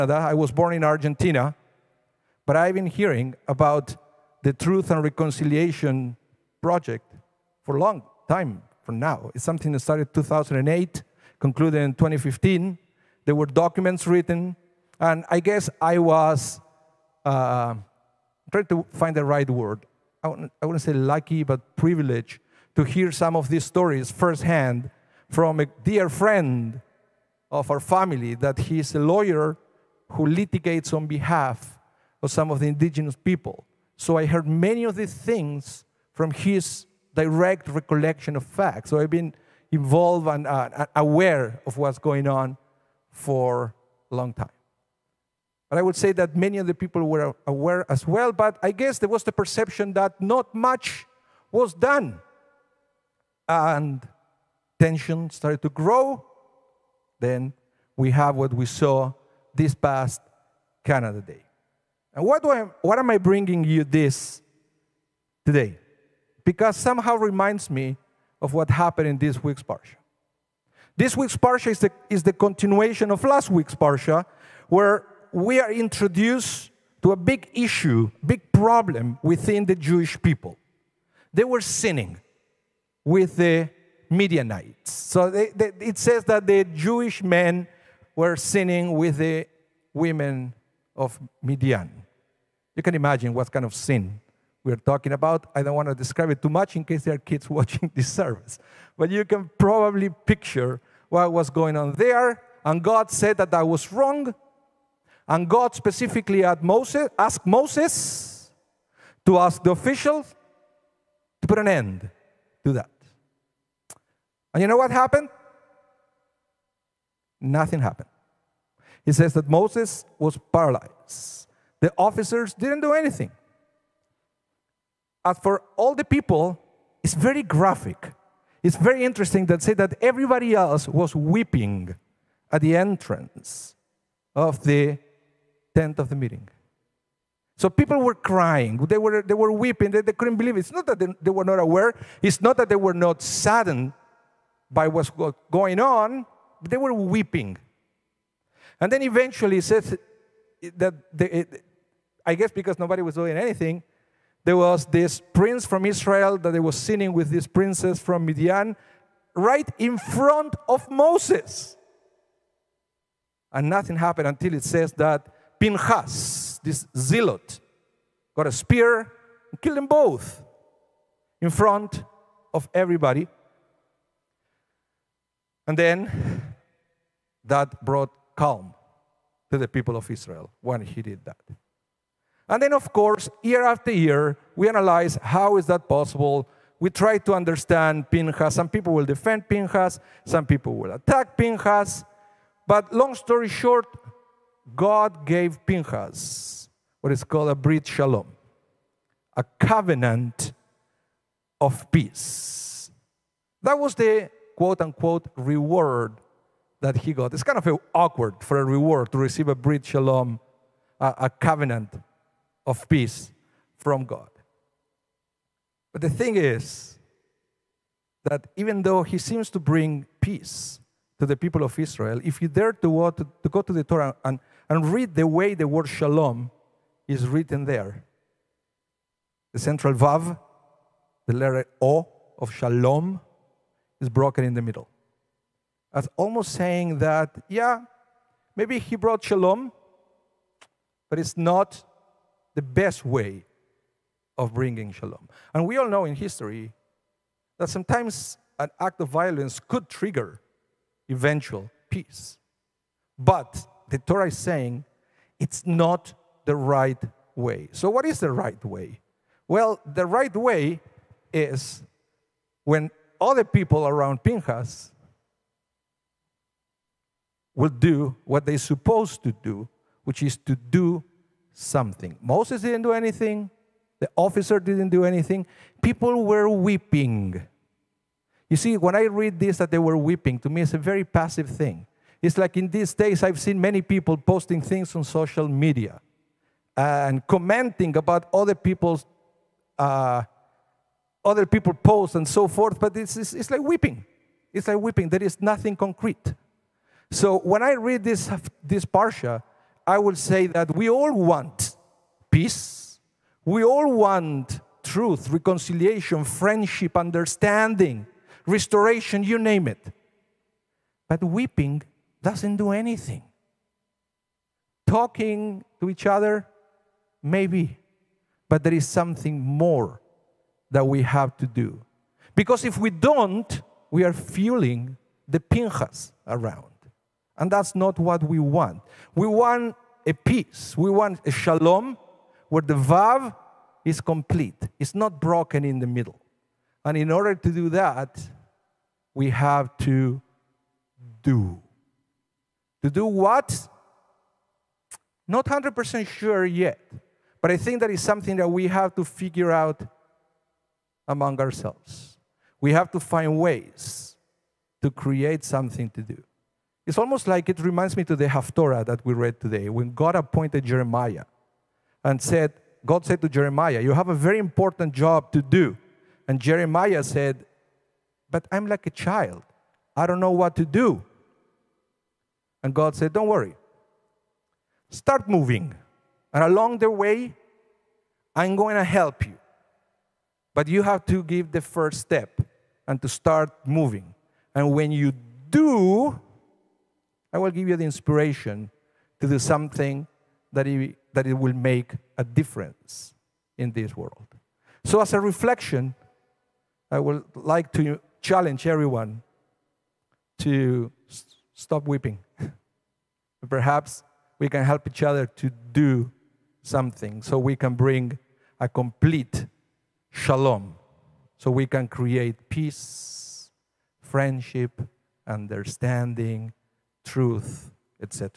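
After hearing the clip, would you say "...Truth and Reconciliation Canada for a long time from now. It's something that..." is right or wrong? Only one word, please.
wrong.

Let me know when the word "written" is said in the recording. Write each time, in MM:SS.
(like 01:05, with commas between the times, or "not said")
00:14, 03:47.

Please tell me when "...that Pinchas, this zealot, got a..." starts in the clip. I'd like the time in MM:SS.
02:44.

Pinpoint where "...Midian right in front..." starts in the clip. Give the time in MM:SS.
02:38.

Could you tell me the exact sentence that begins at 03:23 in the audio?
That was the quote unquote reward that he got.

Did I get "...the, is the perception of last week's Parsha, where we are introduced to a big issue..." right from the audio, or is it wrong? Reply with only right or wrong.
wrong.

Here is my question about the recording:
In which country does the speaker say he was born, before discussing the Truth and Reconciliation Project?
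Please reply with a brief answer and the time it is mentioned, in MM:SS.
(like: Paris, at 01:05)
Argentina, at 00:00.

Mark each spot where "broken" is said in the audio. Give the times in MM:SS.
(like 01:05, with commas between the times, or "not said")
03:54, 05:35.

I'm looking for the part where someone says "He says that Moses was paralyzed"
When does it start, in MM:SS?
01:59.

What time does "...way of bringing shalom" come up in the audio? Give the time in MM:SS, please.
04:03.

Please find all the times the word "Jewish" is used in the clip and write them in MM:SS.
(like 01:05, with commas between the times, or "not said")
01:19, 01:26.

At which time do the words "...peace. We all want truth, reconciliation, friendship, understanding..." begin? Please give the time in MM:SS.
05:02.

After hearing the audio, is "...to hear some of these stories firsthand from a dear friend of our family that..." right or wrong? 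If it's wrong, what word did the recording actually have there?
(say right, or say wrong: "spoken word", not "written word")
right.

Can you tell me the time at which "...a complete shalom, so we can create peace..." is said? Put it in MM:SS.
06:48.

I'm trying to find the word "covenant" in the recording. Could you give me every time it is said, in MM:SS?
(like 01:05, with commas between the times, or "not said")
03:19, 03:31.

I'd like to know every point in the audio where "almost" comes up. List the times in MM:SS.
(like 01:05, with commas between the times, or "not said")
03:56, 05:56.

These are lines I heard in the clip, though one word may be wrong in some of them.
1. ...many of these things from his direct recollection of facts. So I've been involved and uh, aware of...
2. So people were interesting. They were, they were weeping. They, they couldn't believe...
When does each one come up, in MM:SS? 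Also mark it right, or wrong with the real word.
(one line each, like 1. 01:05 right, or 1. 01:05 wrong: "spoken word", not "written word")
1. 00:34 right
2. 02:17 wrong: "crying", not "interesting".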